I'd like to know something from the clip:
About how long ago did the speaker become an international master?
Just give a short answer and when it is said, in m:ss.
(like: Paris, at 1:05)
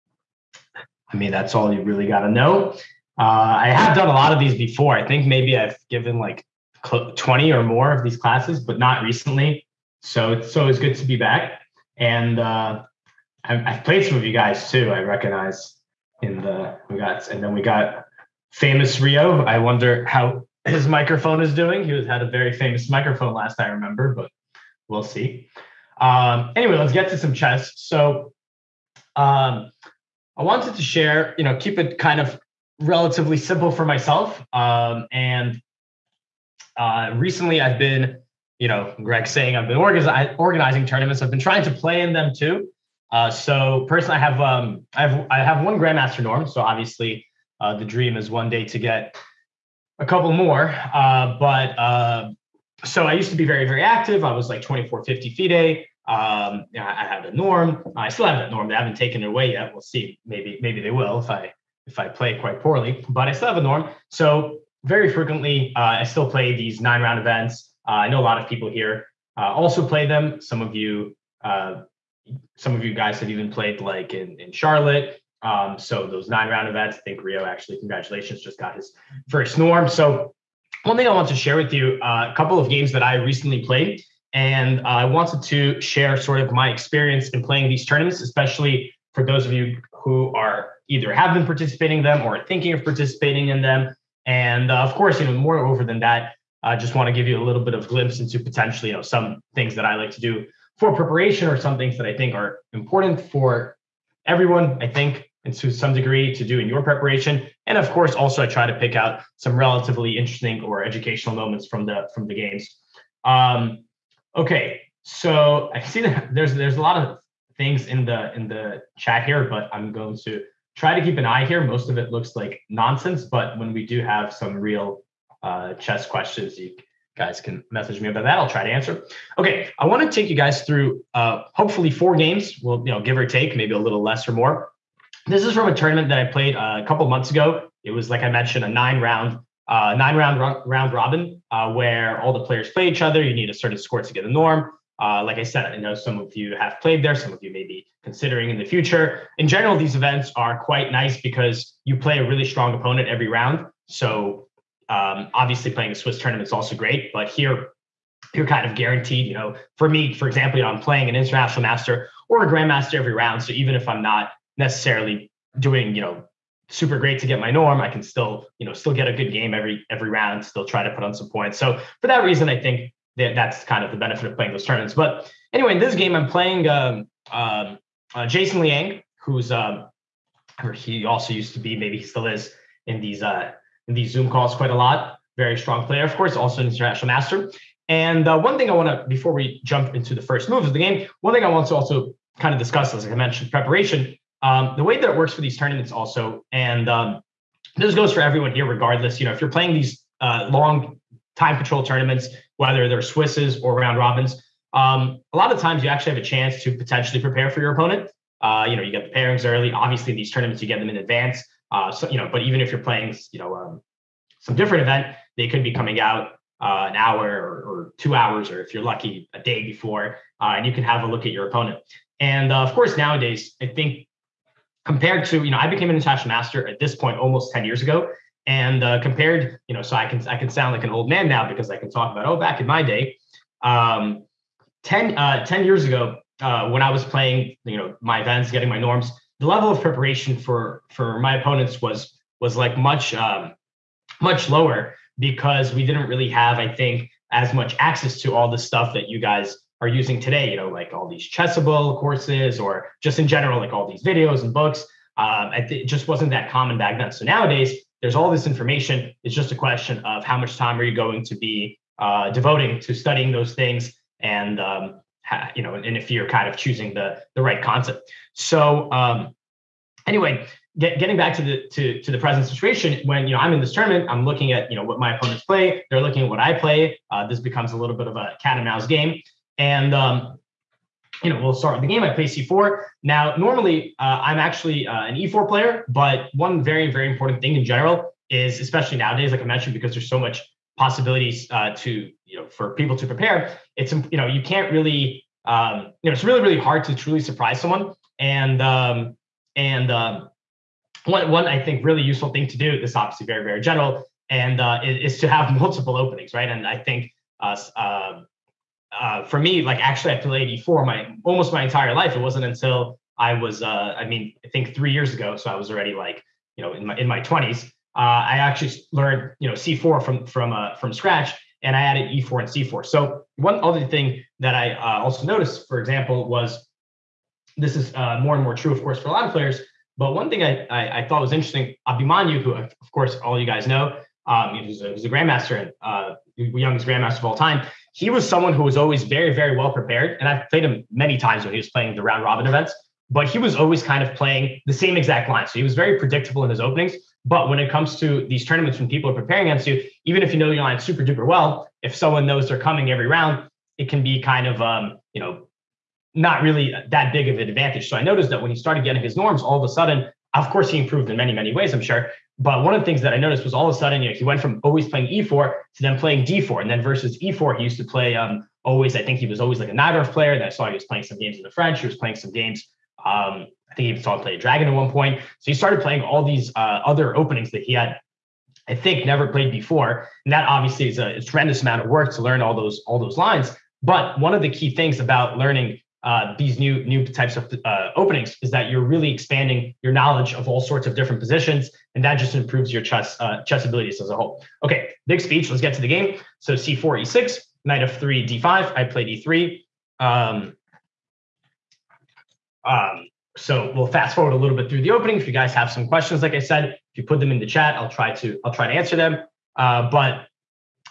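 almost 10 years, at 3:47.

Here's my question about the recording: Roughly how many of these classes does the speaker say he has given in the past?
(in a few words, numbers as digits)
20.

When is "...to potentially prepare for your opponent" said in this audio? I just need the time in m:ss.
3:26.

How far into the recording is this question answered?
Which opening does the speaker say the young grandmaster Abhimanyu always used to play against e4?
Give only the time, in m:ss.
6:09.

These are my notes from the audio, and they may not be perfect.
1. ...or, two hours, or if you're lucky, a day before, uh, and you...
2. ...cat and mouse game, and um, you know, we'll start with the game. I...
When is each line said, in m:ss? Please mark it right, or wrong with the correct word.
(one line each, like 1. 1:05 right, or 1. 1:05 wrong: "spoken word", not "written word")
1. 3:37 right
2. 4:38 right.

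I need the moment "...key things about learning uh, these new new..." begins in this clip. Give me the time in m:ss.
6:24.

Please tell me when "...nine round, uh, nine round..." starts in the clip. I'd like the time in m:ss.
2:18.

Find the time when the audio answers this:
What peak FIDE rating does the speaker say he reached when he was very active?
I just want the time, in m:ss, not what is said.
0:54.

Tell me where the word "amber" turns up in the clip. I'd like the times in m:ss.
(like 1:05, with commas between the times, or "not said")
not said.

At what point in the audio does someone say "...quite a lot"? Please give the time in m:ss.
3:04.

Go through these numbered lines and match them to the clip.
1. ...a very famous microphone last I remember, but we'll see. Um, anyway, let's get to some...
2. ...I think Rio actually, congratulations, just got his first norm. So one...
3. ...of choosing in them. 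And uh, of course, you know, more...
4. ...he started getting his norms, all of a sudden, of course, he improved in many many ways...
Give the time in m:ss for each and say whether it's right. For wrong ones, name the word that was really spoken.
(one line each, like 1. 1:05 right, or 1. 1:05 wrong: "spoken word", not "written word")
1. 0:22 right
2. 1:16 right
3. 1:32 wrong: "participating", not "choosing"
4. 5:58 right.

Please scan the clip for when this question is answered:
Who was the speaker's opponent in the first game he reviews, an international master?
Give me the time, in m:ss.
2:58.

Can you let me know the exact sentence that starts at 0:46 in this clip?
So obviously, uh, the dream is one day to get a couple more.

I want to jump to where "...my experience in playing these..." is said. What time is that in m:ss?
1:26.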